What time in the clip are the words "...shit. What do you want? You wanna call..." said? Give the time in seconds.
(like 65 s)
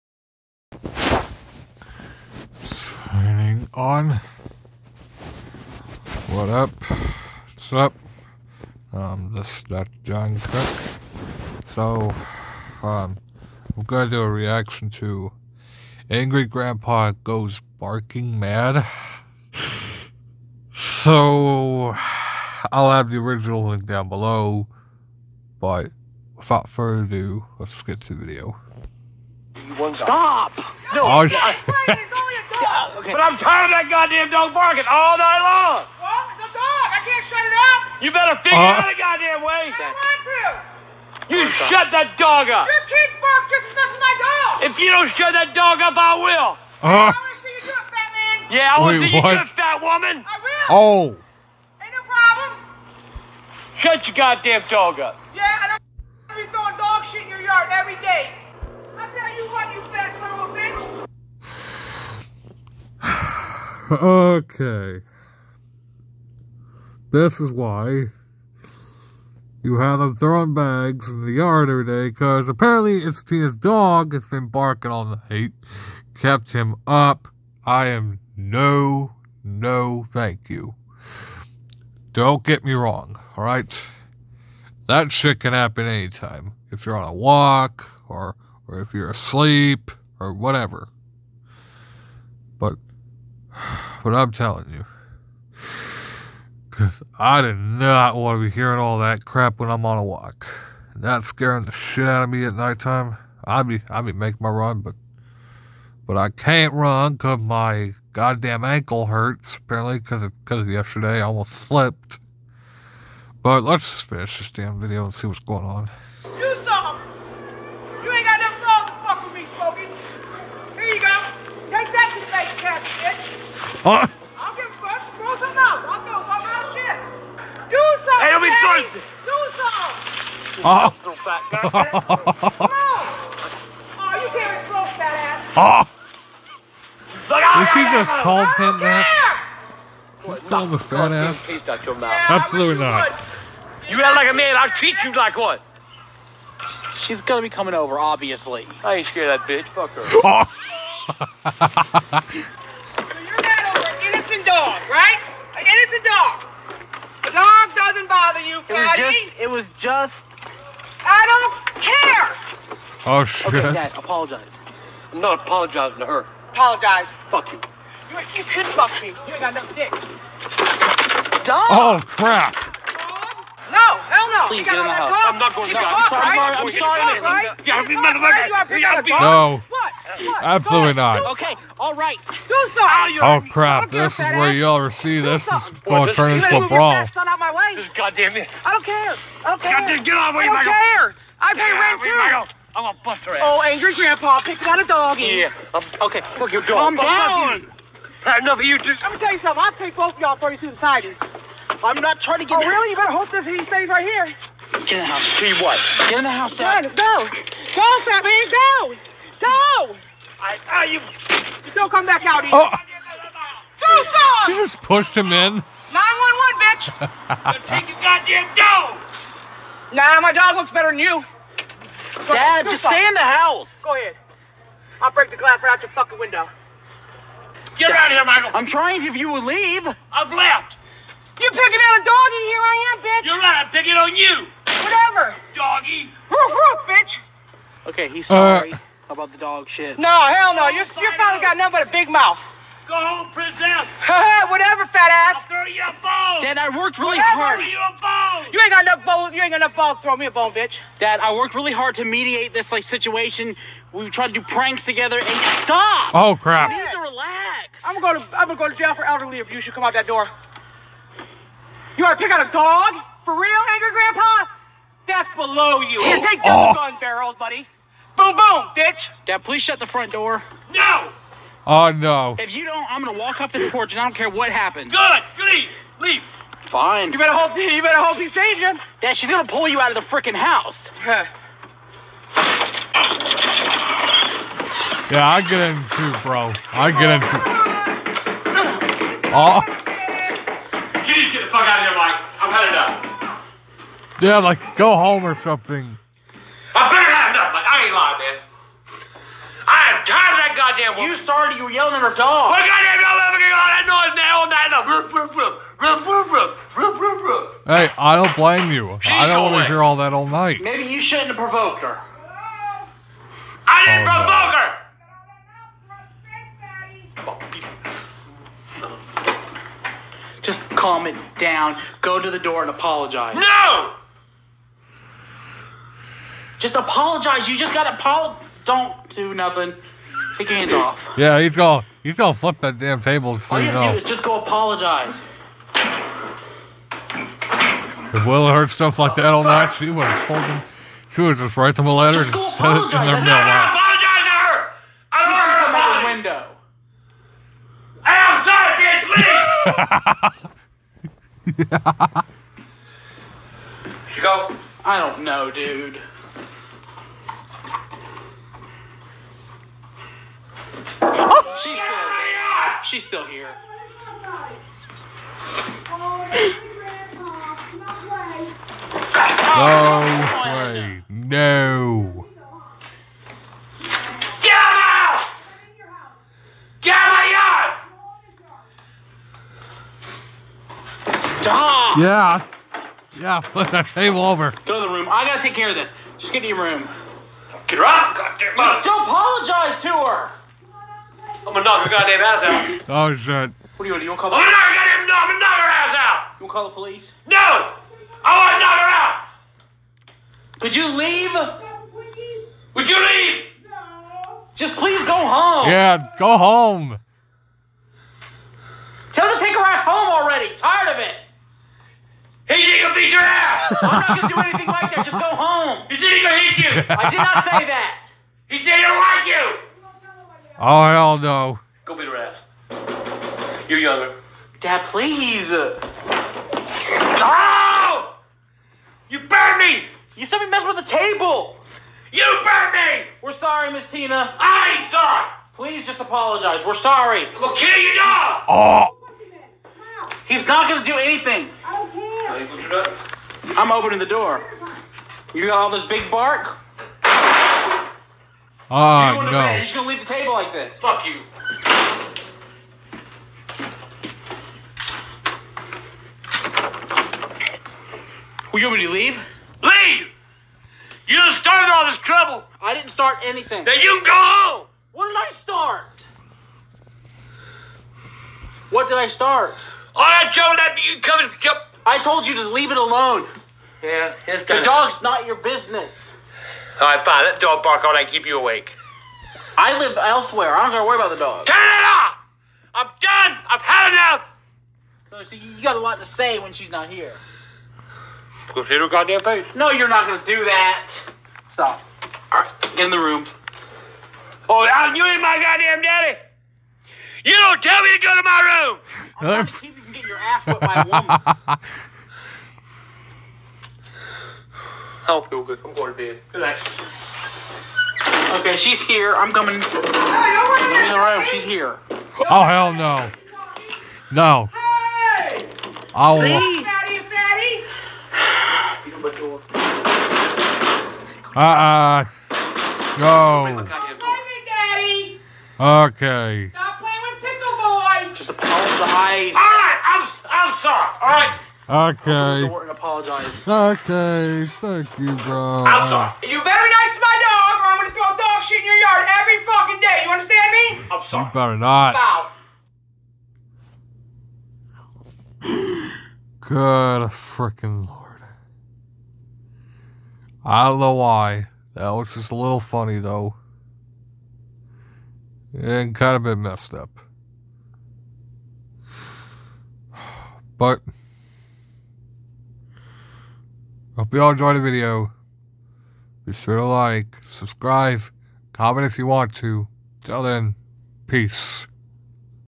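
393 s.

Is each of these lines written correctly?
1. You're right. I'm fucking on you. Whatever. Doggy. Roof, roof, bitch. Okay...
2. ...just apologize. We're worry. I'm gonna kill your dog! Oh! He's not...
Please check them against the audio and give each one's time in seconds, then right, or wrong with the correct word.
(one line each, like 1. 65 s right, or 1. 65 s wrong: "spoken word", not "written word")
1. 233 s wrong: "picking", not "fucking"
2. 435 s wrong: "sorry", not "worry".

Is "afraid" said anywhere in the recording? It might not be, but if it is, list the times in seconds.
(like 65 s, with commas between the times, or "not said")
not said.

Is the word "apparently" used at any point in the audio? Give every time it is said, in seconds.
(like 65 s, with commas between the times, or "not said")
72 s, 109 s.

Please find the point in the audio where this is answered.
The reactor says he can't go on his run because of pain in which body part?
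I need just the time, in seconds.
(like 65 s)
108 s.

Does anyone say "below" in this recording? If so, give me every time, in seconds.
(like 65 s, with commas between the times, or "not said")
24 s, 265 s.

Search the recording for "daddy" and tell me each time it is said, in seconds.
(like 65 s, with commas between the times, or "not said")
495 s.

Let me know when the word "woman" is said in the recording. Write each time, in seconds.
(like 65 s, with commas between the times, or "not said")
49 s, 300 s, 500 s.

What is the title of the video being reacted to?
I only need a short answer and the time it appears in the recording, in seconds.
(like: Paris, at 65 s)
Angry Grandpa Goes Barking Mad, at 16 s.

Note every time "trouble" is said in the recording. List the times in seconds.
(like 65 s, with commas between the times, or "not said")
461 s.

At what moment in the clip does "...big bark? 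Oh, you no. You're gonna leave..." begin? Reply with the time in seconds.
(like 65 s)
445 s.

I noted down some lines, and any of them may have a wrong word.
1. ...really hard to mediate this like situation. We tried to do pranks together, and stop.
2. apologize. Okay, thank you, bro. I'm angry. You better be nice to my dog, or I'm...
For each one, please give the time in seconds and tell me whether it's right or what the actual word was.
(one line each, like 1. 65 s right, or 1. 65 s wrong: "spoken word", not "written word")
1. 251 s right
2. 532 s wrong: "sorry", not "angry".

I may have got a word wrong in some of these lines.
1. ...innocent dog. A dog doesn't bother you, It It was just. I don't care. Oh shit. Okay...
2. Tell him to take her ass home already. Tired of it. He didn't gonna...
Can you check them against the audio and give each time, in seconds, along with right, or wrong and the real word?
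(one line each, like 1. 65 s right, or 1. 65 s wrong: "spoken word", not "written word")
1. 155 s right
2. 409 s right.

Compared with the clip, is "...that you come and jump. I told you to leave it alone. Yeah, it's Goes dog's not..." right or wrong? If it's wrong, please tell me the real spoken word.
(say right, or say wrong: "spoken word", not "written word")
wrong: "The", not "Goes".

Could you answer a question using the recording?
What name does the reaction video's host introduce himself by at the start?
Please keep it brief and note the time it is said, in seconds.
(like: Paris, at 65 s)
Dr. Jon Cook, at 9 s.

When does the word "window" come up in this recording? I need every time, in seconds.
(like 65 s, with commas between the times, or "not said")
226 s, 350 s.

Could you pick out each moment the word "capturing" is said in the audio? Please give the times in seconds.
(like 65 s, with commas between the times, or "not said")
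not said.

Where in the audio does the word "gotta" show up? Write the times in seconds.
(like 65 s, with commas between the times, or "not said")
327 s, 385 s, 480 s.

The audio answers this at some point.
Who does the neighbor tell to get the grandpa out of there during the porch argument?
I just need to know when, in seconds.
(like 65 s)
228 s.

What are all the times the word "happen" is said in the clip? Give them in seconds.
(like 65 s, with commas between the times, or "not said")
85 s, 274 s.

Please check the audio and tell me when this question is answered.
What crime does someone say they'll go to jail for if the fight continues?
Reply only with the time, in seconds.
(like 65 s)
259 s.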